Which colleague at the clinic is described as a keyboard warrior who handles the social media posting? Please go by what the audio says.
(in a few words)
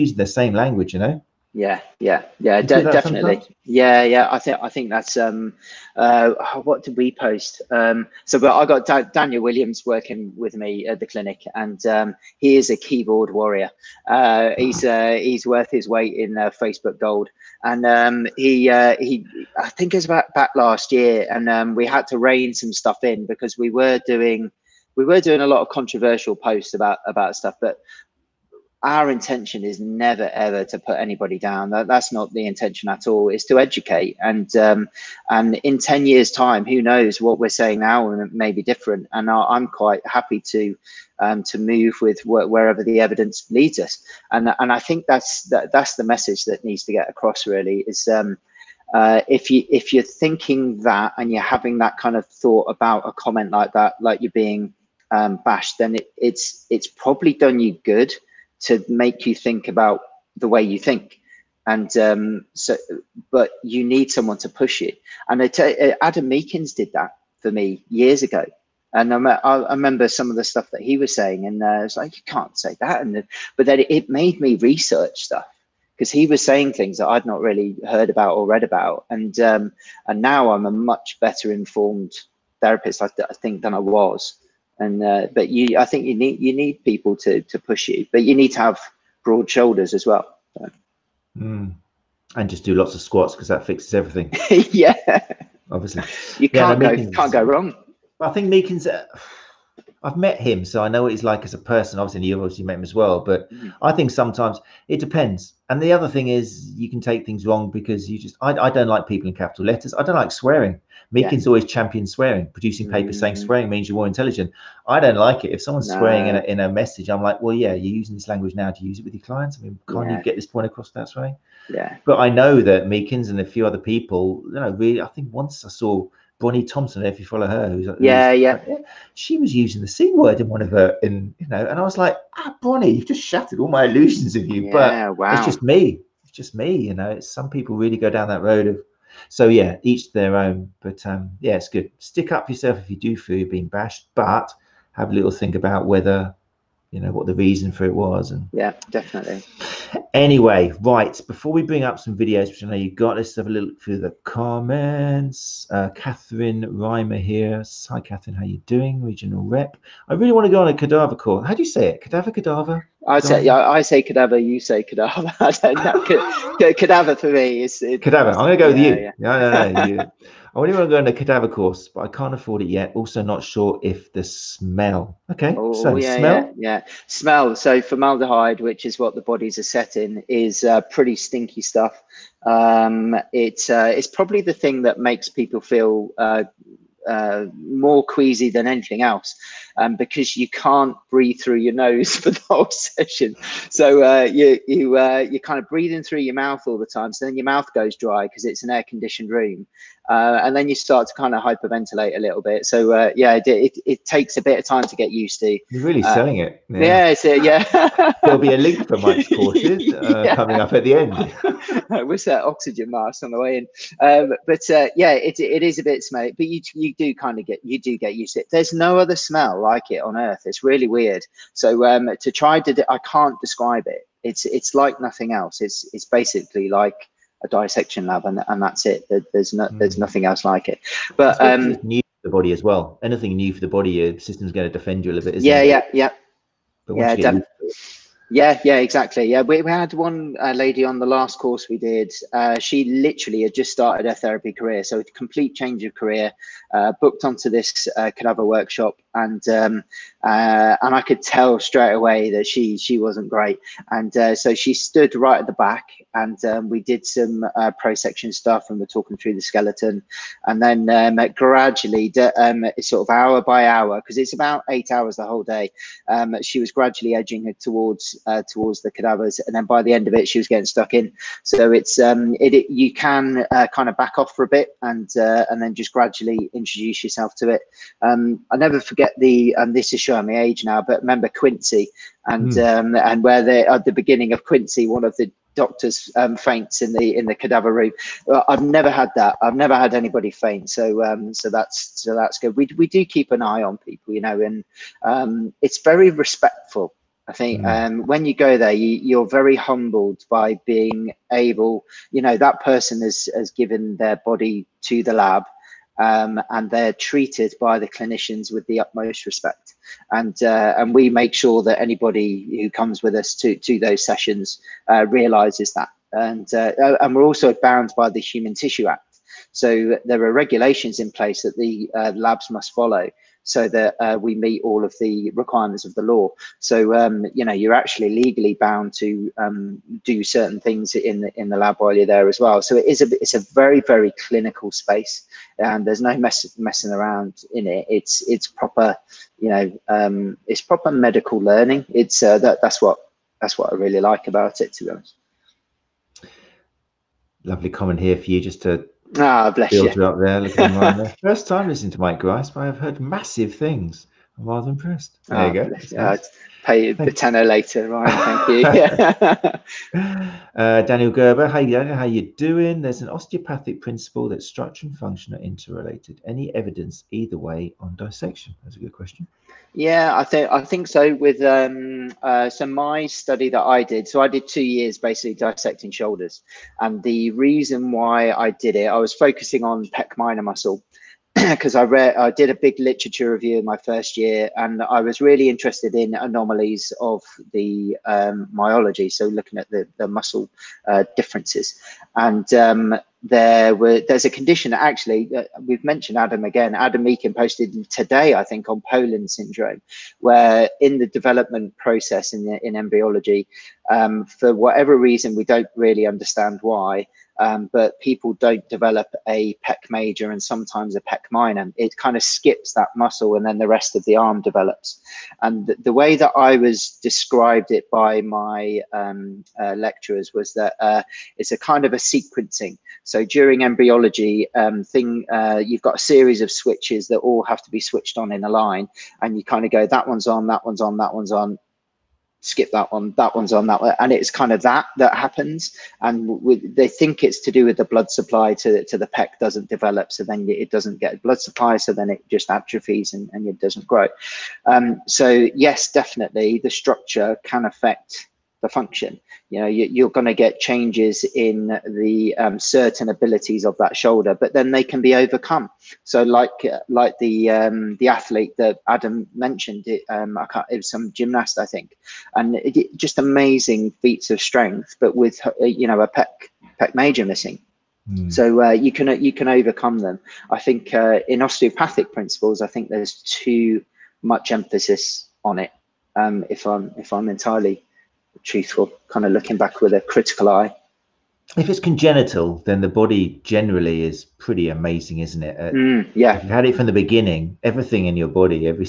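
Daniel Williams.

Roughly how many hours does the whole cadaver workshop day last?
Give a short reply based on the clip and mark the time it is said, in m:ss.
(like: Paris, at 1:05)
8 hours, at 4:24.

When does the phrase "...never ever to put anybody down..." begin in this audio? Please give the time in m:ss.
0:29.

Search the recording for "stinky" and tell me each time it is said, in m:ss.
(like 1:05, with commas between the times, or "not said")
3:01.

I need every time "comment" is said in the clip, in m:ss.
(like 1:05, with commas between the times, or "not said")
0:53, 2:34, 5:47.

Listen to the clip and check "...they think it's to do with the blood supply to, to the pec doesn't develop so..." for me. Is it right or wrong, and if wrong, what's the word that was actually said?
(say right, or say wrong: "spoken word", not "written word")
right.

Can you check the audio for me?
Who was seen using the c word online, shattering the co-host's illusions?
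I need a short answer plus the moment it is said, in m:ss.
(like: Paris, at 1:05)
Bonnie Thompson, at 2:06.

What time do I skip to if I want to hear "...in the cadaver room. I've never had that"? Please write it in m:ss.
4:47.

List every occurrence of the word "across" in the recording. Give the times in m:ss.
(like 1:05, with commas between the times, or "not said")
0:47, 2:00.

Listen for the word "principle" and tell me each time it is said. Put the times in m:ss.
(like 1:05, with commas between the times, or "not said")
6:03, 7:52.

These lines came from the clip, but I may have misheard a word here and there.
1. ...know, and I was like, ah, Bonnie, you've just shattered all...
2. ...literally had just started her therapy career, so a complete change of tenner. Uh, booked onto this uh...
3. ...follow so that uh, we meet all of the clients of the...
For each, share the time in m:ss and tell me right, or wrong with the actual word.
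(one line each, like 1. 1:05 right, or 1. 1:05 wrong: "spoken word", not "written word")
1. 2:11 right
2. 4:02 wrong: "career", not "tenner"
3. 5:22 wrong: "requirements", not "clients".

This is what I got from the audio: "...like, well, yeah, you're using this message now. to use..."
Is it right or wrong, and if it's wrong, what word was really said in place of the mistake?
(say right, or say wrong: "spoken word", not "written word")
wrong: "language", not "message".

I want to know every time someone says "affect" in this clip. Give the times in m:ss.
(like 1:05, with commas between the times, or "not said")
7:27.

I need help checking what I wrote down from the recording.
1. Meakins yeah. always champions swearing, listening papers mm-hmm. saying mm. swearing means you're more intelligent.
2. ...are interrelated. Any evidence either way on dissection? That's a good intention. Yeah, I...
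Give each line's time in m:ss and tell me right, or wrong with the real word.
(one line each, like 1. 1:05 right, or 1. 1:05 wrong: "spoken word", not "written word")
1. 1:51 wrong: "producing", not "listening"
2. 6:05 wrong: "question", not "intention".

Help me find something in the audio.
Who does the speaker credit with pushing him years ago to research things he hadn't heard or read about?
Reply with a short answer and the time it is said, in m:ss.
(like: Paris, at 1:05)
Adam Meakins, at 1:06.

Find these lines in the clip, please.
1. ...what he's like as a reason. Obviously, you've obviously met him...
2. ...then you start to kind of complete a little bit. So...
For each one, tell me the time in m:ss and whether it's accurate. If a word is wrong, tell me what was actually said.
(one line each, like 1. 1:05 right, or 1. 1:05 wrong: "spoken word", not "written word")
1. 1:41 wrong: "person", not "reason"
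2. 3:20 wrong: "hyperventilate", not "complete".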